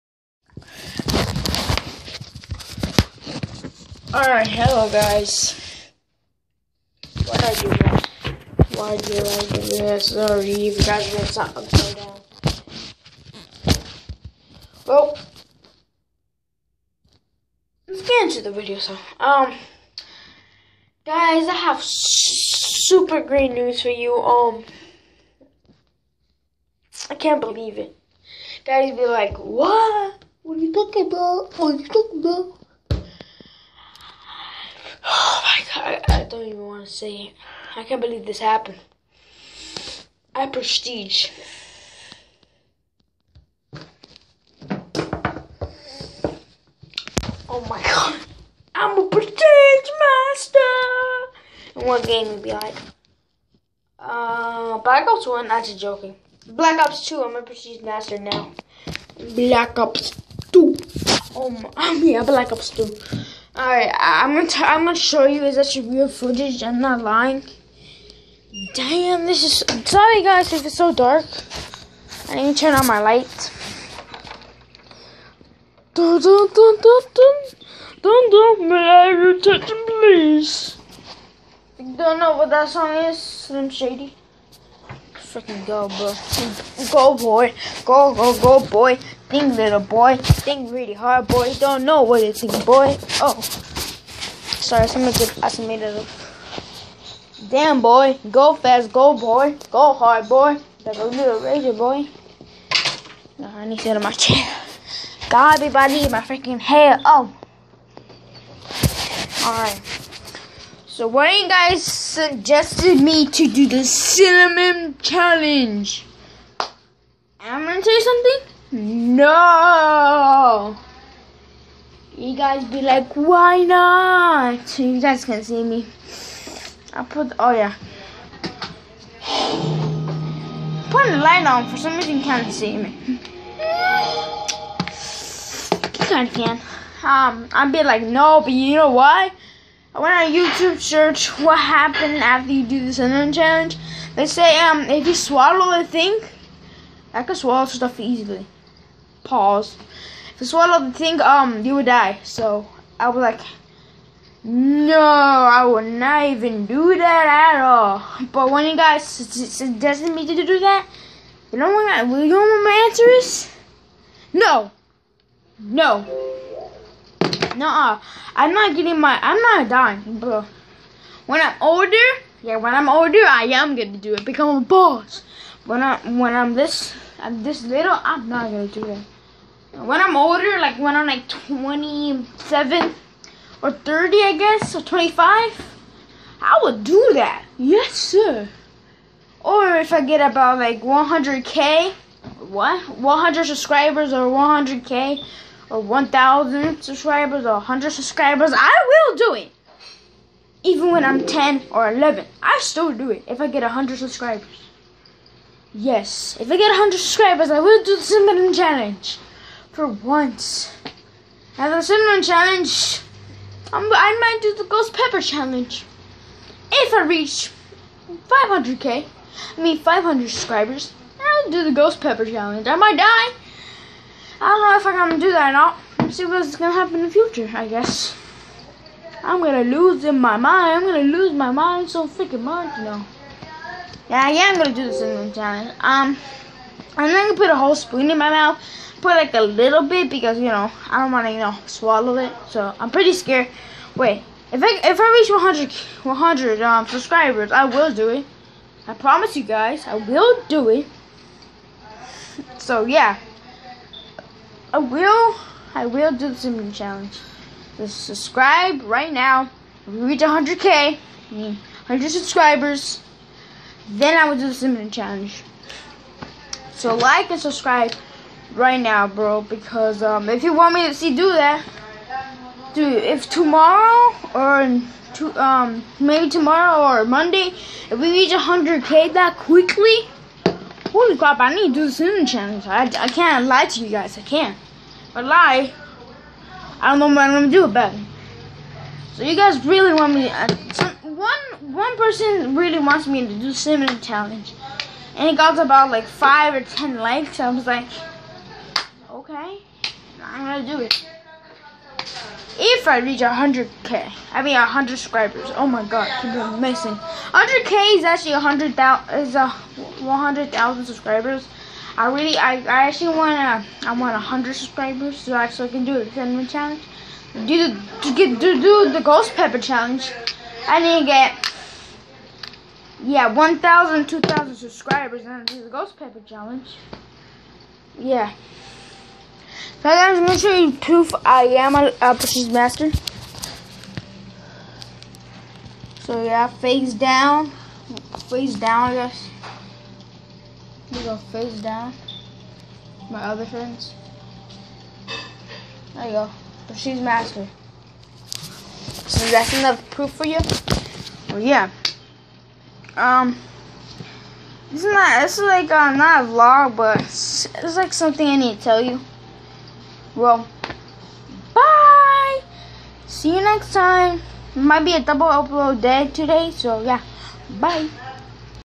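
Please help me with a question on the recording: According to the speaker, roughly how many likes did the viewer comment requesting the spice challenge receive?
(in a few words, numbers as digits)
5 or 10.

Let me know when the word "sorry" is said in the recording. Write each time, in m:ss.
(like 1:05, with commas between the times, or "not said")
0:10, 1:09, 1:33.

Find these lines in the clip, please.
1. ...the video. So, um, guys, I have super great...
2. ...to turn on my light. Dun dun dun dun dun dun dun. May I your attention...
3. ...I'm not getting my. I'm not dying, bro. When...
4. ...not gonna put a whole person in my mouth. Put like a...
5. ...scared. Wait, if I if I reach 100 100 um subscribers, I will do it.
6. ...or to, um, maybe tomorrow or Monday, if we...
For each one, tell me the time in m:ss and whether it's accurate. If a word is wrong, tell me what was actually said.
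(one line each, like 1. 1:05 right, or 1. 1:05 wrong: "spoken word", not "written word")
1. 0:18 right
2. 1:12 right
3. 2:48 right
4. 3:57 wrong: "spoon", not "person"
5. 4:03 right
6. 4:34 right.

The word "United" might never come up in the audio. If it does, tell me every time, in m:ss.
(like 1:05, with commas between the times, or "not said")
not said.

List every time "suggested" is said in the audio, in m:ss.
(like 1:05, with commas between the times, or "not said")
1:51, 2:39.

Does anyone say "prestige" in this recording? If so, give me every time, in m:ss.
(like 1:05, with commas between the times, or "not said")
0:40, 0:49, 0:57.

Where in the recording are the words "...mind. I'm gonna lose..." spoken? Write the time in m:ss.
3:50.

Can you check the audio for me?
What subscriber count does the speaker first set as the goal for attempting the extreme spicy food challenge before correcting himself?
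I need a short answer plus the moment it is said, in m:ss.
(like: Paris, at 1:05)
500, at 3:39.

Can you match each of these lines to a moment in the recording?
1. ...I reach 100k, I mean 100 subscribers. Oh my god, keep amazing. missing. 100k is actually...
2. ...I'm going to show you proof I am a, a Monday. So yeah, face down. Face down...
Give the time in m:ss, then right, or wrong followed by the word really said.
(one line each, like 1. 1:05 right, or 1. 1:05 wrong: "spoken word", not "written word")
1. 5:02 right
2. 5:30 wrong: "Master", not "Monday".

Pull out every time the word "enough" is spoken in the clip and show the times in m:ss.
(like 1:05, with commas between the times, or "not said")
5:49.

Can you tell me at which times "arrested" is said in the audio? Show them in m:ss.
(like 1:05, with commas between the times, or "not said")
not said.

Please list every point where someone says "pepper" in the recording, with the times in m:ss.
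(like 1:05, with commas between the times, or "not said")
3:34, 3:42, 5:19, 5:25.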